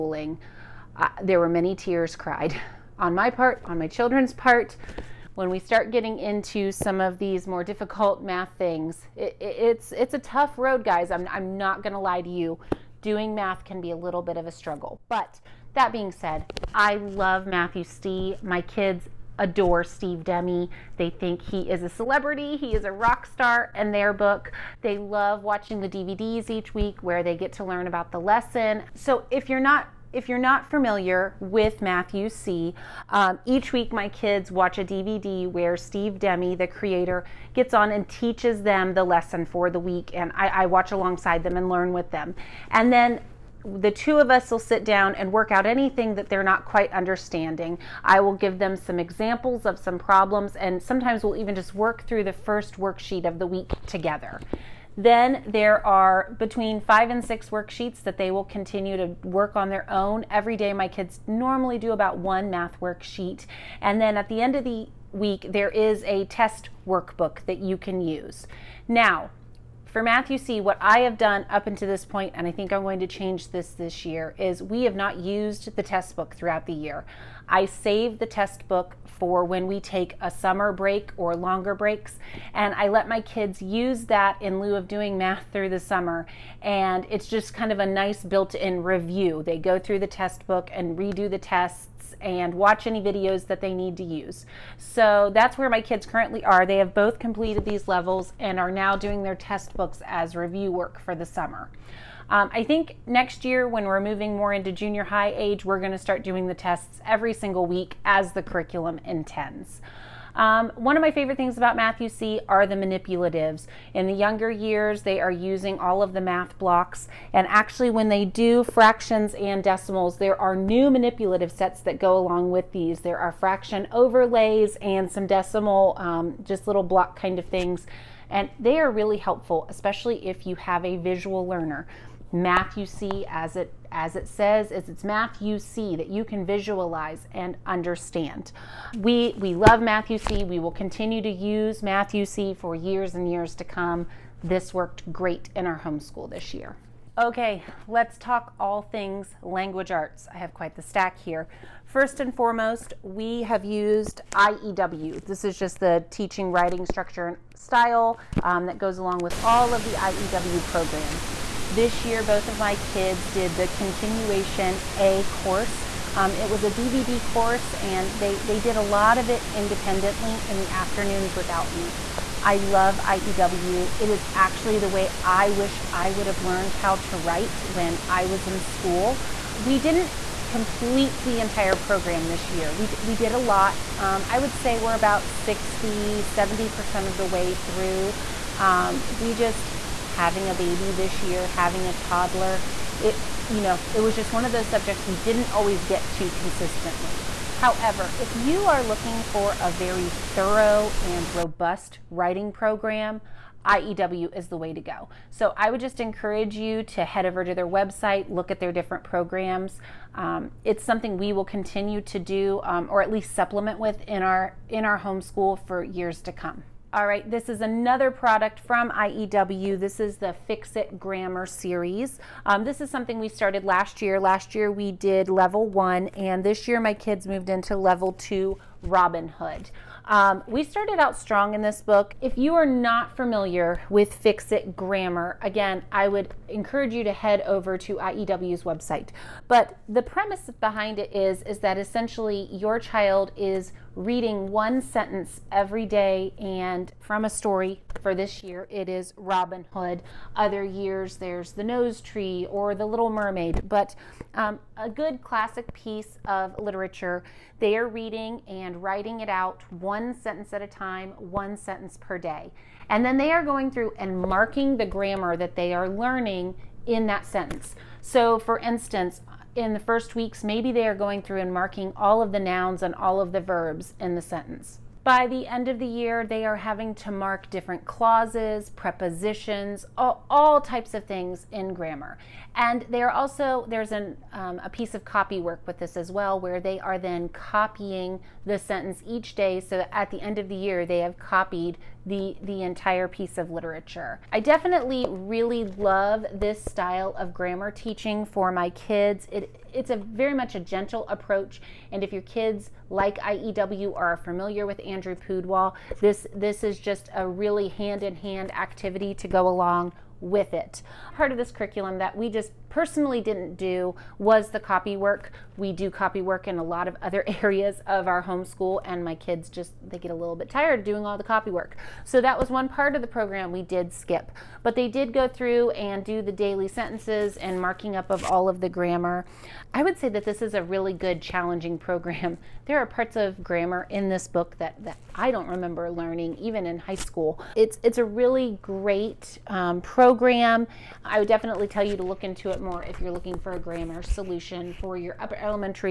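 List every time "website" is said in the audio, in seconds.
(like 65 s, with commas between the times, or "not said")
207 s, 238 s.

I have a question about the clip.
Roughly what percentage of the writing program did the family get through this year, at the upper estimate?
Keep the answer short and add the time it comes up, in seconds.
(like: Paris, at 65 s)
70%, at 186 s.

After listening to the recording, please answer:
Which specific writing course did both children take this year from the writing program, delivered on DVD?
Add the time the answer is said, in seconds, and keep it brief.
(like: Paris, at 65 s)
Continuation A, at 163 s.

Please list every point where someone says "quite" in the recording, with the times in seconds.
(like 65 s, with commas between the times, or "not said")
46 s, 150 s.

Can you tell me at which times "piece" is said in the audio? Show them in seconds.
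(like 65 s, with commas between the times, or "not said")
255 s, 284 s, 293 s.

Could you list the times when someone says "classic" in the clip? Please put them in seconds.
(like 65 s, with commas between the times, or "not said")
255 s.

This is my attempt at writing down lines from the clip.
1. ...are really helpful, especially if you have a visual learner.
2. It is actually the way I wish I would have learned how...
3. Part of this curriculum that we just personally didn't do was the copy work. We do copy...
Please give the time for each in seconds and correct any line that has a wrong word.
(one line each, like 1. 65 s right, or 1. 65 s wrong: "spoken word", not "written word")
1. 128 s right
2. 173 s right
3. 311 s right.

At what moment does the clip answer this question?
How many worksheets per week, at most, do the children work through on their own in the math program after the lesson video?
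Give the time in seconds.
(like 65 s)
56 s.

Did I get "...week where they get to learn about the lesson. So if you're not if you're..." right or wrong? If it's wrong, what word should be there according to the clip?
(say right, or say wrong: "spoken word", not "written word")
right.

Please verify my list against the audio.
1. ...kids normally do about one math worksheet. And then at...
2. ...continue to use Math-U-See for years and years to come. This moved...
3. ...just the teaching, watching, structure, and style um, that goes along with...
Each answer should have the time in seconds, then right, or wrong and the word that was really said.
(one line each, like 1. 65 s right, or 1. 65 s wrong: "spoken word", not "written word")
1. 60 s right
2. 140 s wrong: "worked", not "moved"
3. 155 s wrong: "writing", not "watching".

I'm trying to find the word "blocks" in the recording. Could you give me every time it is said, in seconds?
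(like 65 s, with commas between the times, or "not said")
116 s, 126 s.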